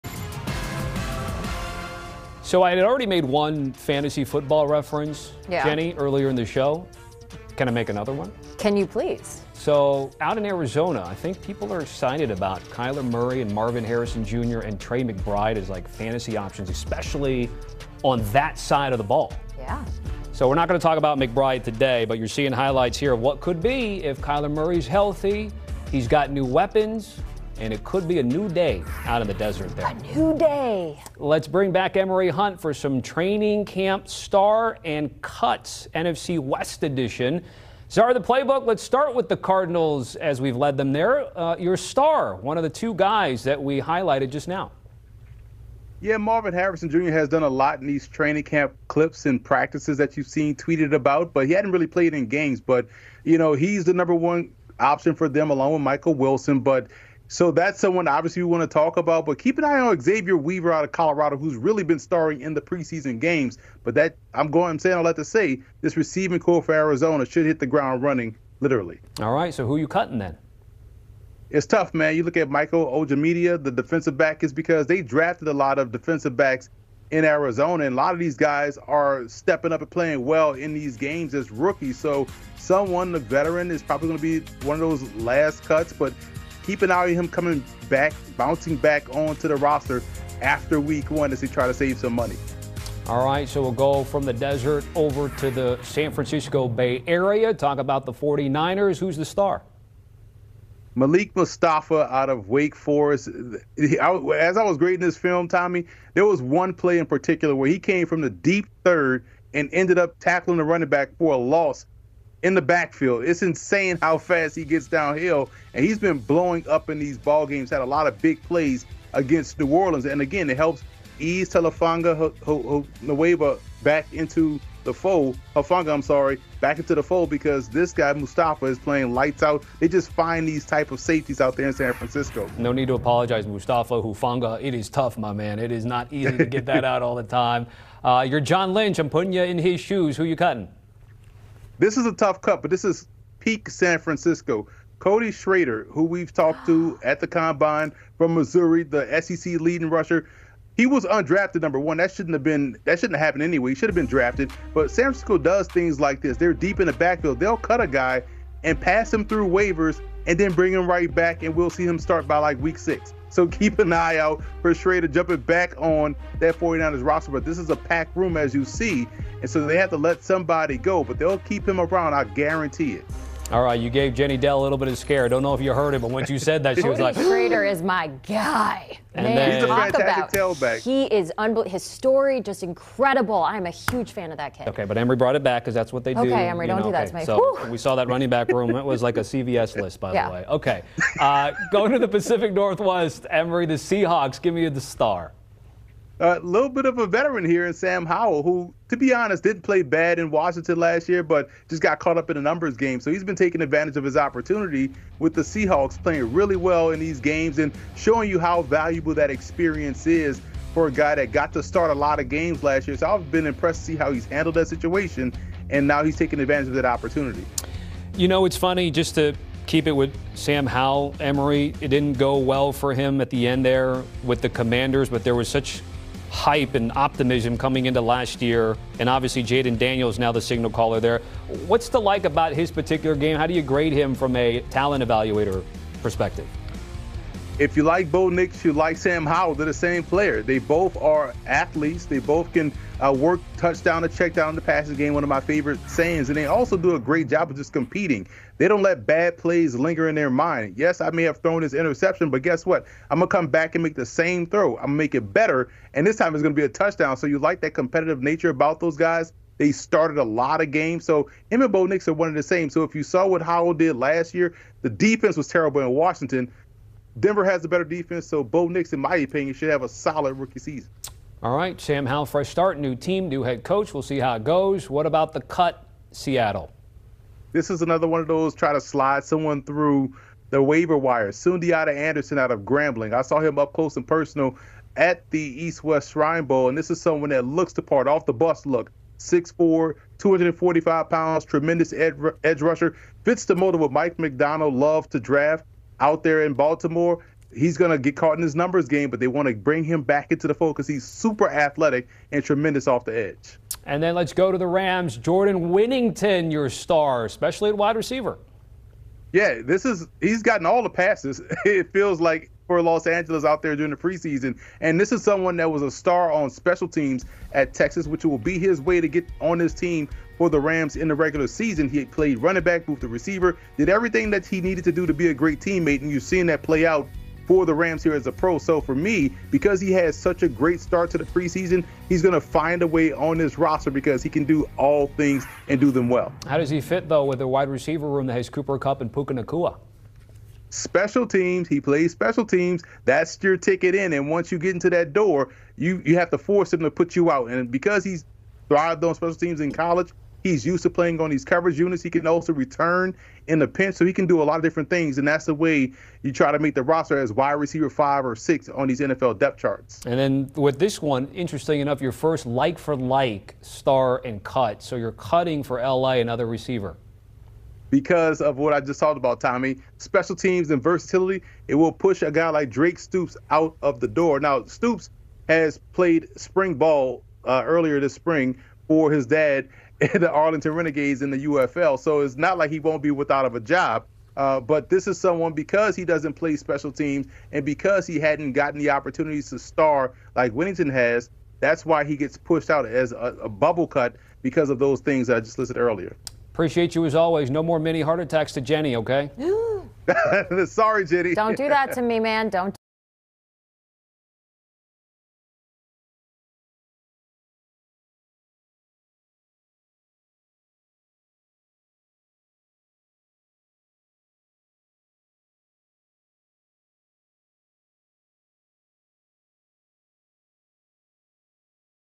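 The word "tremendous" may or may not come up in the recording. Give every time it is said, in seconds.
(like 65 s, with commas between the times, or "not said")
291 s, 302 s.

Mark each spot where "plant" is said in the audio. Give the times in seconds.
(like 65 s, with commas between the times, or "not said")
not said.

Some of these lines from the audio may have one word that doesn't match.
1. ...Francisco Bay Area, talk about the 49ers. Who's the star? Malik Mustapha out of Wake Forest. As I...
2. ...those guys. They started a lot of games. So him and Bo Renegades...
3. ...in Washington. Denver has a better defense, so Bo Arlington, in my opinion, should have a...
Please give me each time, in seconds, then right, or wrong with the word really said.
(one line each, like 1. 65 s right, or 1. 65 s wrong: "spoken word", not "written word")
1. 96 s right
2. 258 s wrong: "Nix", not "Renegades"
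3. 265 s wrong: "Nix", not "Arlington".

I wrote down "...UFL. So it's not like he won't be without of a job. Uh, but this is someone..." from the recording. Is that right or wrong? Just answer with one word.
right.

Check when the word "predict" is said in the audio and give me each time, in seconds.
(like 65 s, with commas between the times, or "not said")
not said.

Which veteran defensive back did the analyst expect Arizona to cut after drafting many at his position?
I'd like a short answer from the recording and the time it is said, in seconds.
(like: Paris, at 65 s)
Michael Ojemudia, at 72 s.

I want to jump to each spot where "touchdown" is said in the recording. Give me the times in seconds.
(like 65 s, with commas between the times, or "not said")
243 s, 256 s.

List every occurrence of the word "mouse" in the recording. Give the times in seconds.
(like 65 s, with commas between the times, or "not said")
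not said.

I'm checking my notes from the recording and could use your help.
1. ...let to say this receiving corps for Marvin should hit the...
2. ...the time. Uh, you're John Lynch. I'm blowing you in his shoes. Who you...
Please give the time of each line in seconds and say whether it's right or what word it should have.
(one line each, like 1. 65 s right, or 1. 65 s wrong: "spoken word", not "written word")
1. 65 s wrong: "Arizona", not "Marvin"
2. 137 s wrong: "putting", not "blowing".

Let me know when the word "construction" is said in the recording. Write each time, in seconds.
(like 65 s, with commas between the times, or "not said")
not said.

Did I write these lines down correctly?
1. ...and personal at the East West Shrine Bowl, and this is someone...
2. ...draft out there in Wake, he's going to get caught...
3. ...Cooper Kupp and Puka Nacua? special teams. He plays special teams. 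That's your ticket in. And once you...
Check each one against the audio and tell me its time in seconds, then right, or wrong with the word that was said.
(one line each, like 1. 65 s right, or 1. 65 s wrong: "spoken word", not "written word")
1. 283 s right
2. 295 s wrong: "Baltimore", not "Wake"
3. 338 s right.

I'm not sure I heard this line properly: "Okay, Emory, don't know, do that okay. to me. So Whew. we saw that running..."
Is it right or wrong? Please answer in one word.
right.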